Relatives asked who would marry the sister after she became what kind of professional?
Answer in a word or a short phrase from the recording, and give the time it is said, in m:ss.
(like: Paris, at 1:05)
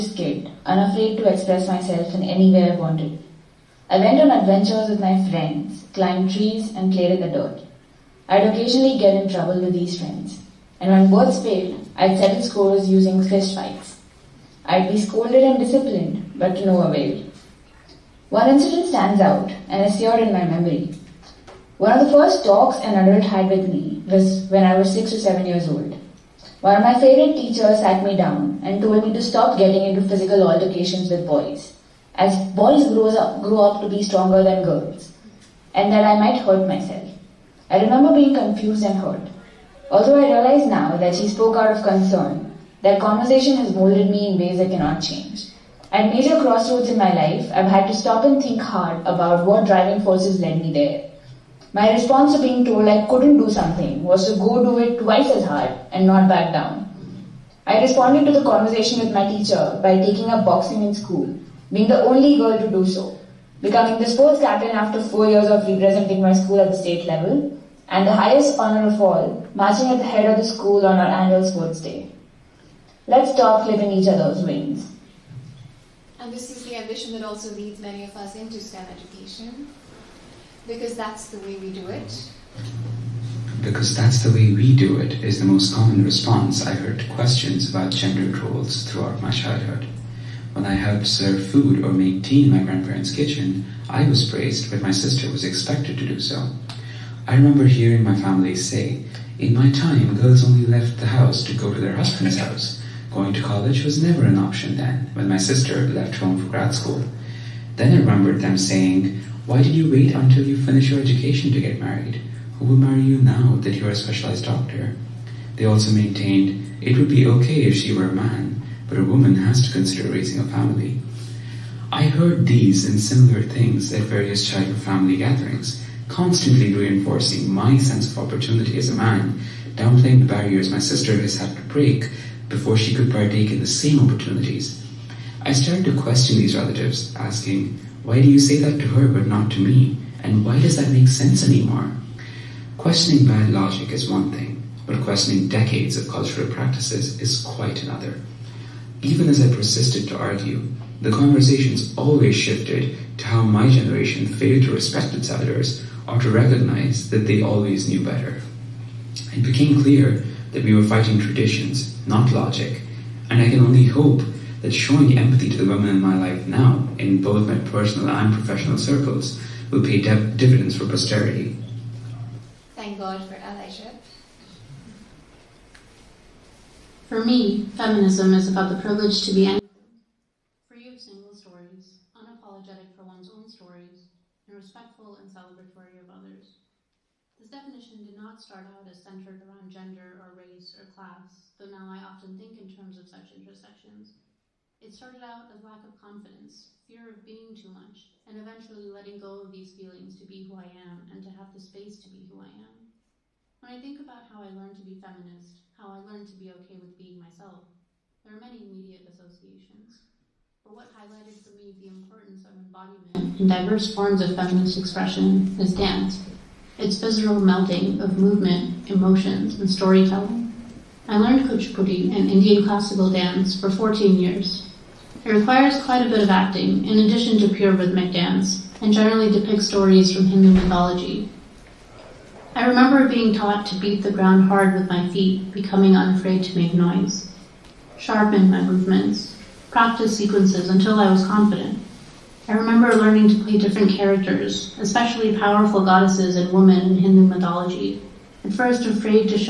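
Specialized doctor, at 1:53.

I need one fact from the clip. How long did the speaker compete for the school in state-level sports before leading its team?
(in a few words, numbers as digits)
4 years.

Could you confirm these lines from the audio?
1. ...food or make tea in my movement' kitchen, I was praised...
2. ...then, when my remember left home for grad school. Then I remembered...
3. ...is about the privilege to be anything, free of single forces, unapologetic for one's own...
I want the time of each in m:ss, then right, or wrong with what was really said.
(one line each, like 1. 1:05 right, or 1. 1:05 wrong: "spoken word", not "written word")
1. 1:31 wrong: "grandparents", not "movement"
2. 1:44 wrong: "sister", not "remember"
3. 2:58 wrong: "stories", not "forces".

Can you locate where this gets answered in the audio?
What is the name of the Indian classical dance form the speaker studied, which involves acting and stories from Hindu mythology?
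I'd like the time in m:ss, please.
3:41.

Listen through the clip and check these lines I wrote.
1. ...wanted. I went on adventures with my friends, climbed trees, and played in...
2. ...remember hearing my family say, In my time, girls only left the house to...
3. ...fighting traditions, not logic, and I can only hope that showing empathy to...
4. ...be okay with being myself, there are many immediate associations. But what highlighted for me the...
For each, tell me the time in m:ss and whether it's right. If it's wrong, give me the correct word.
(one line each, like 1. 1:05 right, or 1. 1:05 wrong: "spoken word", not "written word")
1. 0:02 right
2. 1:37 right
3. 2:40 right
4. 3:26 right.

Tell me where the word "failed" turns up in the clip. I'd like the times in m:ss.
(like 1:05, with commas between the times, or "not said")
0:11, 2:34.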